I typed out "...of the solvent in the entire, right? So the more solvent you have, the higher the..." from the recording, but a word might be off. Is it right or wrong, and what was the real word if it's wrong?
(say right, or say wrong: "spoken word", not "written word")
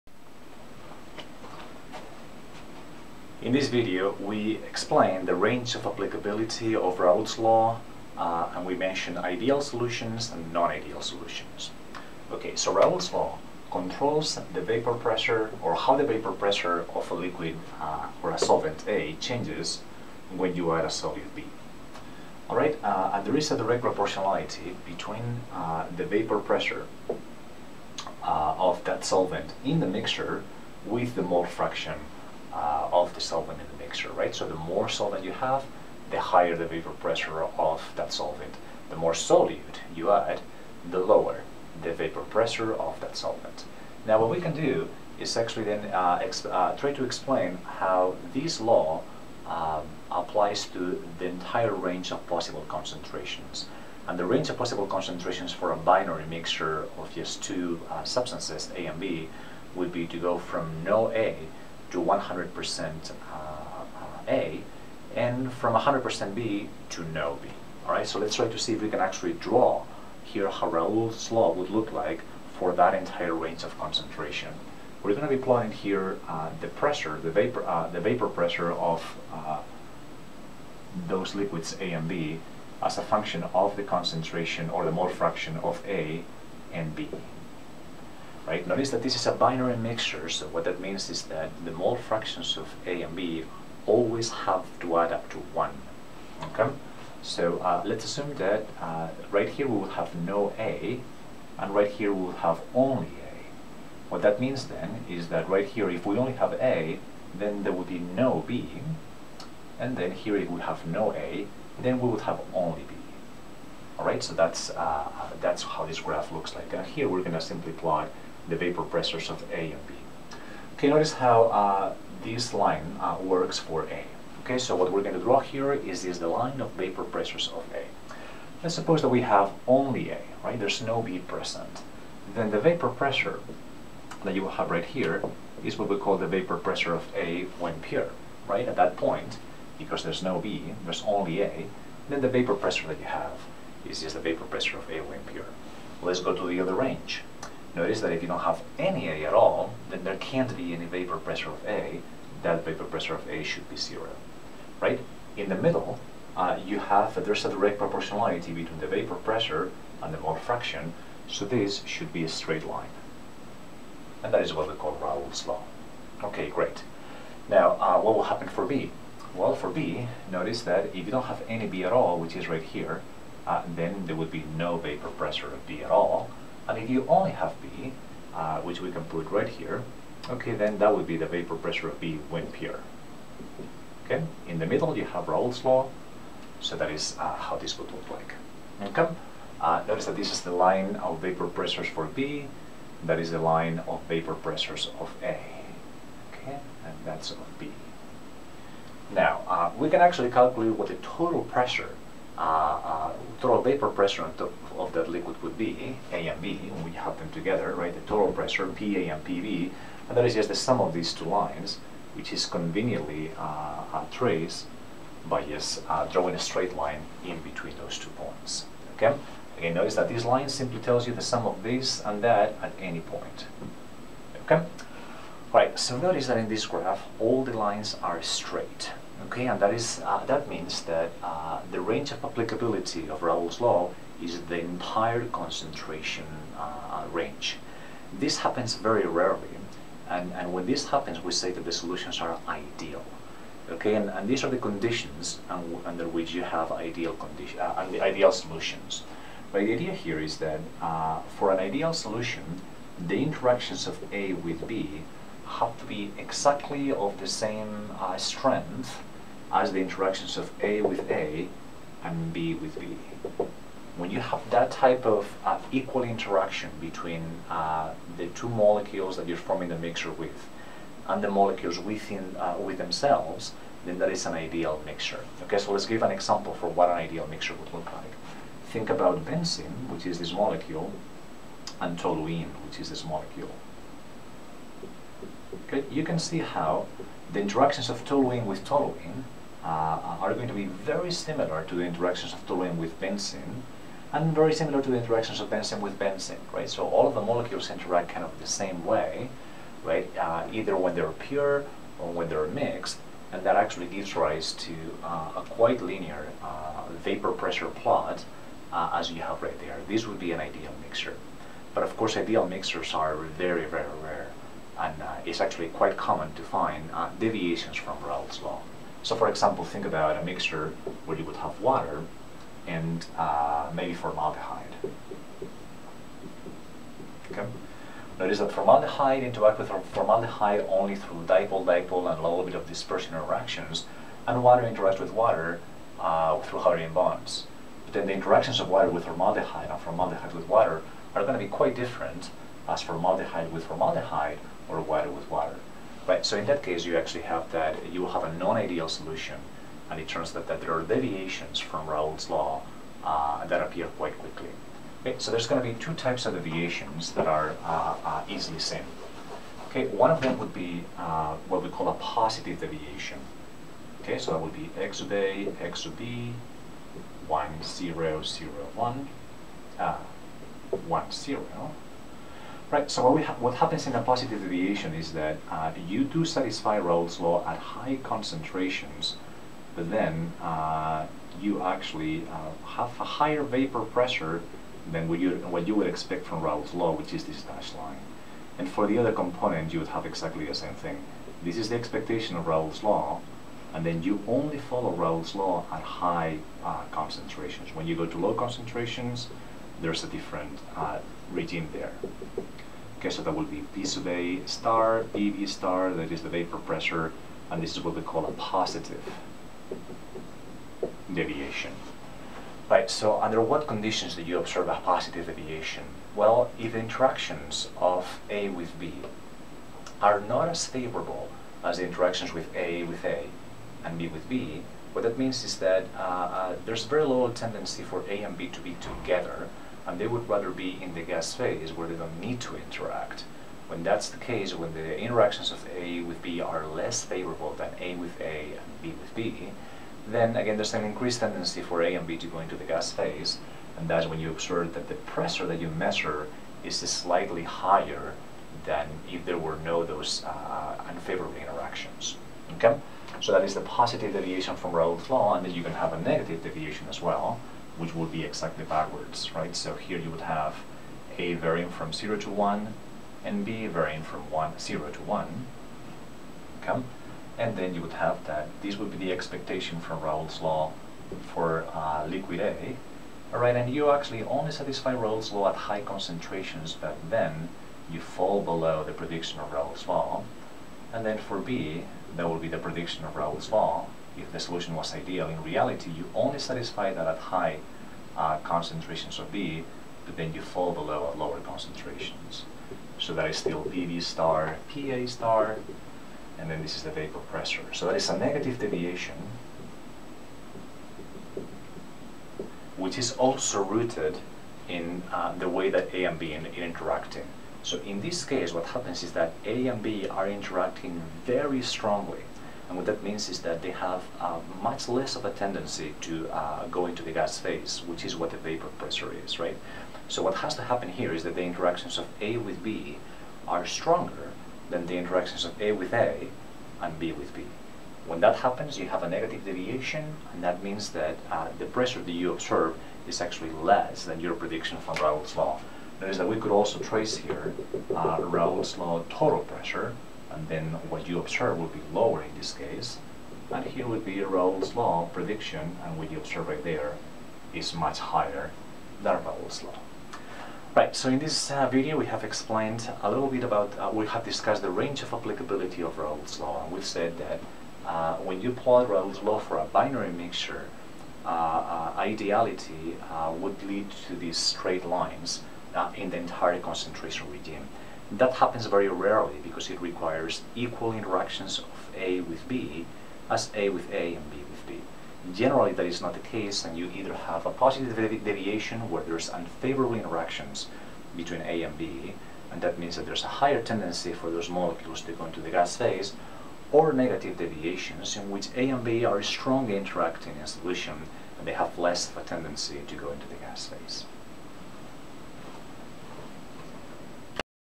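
wrong: "mixture", not "entire".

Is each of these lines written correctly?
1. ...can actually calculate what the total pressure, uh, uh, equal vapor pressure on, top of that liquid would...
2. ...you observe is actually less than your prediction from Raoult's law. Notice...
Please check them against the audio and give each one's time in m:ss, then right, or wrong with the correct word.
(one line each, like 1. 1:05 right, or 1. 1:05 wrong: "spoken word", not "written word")
1. 3:19 wrong: "total", not "equal"
2. 8:52 right.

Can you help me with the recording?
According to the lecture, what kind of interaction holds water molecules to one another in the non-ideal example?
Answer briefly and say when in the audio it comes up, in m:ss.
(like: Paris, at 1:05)
hydrogen bonds, at 5:36.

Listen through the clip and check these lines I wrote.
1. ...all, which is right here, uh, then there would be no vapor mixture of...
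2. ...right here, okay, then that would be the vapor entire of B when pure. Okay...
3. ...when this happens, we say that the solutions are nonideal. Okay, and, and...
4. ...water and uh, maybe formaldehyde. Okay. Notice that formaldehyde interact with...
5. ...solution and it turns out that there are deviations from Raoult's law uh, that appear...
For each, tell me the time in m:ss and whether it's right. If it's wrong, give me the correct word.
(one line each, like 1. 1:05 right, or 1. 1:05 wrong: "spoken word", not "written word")
1. 2:51 wrong: "pressure", not "mixture"
2. 2:59 wrong: "pressure", not "entire"
3. 4:00 wrong: "ideal", not "nonideal"
4. 5:21 right
5. 5:48 right.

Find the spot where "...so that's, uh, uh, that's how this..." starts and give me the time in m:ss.
1:54.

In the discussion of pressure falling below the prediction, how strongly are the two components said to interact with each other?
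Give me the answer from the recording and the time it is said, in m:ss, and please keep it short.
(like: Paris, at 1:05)
very strongly, at 8:31.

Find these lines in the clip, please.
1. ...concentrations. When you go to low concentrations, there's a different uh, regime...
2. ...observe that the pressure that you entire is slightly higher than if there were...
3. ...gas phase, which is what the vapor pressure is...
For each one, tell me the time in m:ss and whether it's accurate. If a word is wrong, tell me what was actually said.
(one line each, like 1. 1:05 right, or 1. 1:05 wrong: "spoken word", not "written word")
1. 6:36 right
2. 7:24 wrong: "measure", not "entire"
3. 8:37 right.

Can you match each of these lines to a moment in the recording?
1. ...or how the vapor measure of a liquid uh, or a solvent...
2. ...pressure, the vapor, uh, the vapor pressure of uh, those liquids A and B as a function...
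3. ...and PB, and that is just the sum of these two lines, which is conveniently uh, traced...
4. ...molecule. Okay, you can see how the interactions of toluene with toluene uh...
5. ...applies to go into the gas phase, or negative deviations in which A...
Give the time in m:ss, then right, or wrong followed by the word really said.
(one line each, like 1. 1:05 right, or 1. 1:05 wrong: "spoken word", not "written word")
1. 0:15 wrong: "pressure", not "measure"
2. 1:16 right
3. 3:28 right
4. 4:43 right
5. 9:44 wrong: "molecules", not "applies".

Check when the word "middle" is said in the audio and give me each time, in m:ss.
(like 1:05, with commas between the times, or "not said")
2:35, 3:04.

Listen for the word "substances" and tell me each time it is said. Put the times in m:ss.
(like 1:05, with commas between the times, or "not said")
0:58.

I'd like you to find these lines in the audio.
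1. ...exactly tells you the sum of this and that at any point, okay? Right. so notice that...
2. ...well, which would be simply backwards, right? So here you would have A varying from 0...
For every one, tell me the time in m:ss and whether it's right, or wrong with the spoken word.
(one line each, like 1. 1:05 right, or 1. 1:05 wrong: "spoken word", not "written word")
1. 3:40 wrong: "simply", not "exactly"
2. 7:37 wrong: "exactly", not "simply".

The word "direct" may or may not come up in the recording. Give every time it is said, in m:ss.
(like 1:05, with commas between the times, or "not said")
0:23, 2:37.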